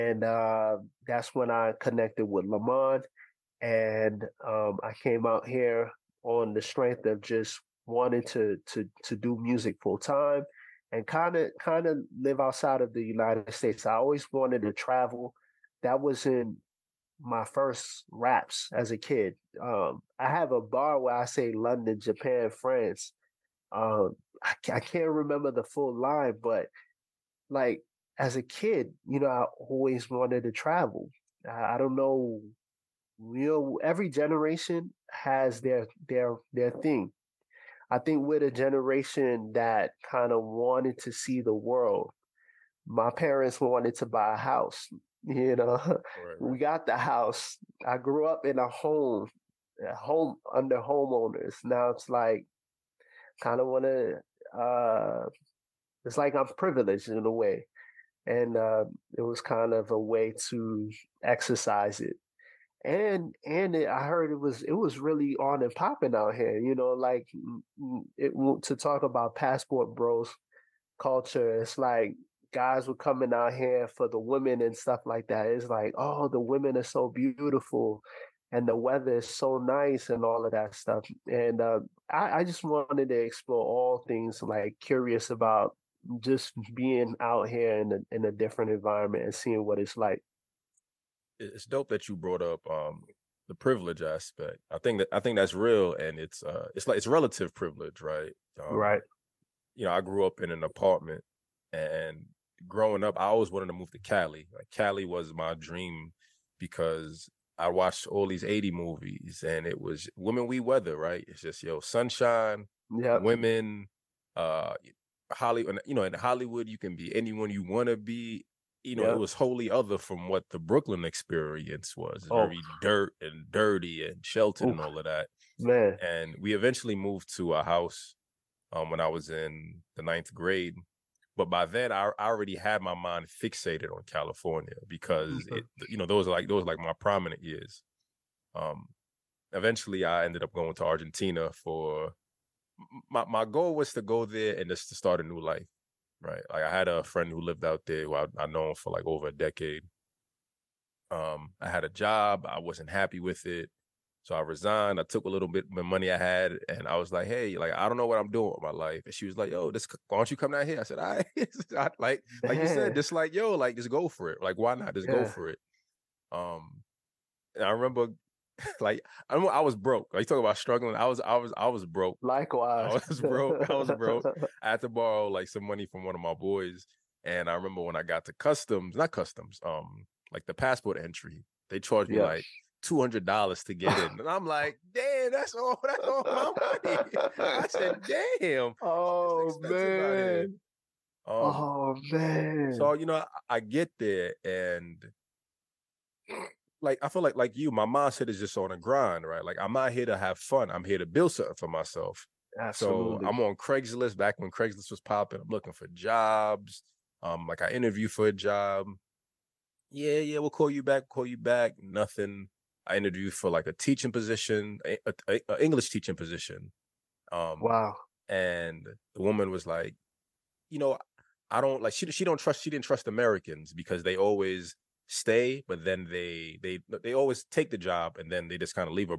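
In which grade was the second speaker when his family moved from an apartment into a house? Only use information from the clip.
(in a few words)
9th grade.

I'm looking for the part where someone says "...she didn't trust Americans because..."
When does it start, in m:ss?
3:42.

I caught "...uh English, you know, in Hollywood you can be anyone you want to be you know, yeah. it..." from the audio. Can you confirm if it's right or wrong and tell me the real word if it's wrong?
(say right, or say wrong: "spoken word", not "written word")
wrong: "Hollywood", not "English".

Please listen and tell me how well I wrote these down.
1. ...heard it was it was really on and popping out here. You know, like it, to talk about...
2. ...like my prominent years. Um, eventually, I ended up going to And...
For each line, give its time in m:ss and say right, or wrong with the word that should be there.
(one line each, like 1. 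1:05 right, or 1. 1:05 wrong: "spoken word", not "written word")
1. 1:04 right
2. 2:16 wrong: "Argentina", not "And".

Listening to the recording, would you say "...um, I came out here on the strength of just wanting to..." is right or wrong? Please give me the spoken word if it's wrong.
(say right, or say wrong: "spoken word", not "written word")
right.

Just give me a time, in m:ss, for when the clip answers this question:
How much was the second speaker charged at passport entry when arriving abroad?
3:02.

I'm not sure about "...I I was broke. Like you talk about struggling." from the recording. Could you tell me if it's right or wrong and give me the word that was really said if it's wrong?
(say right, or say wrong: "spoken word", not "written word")
right.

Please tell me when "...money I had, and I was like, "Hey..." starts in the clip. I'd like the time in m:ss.
2:35.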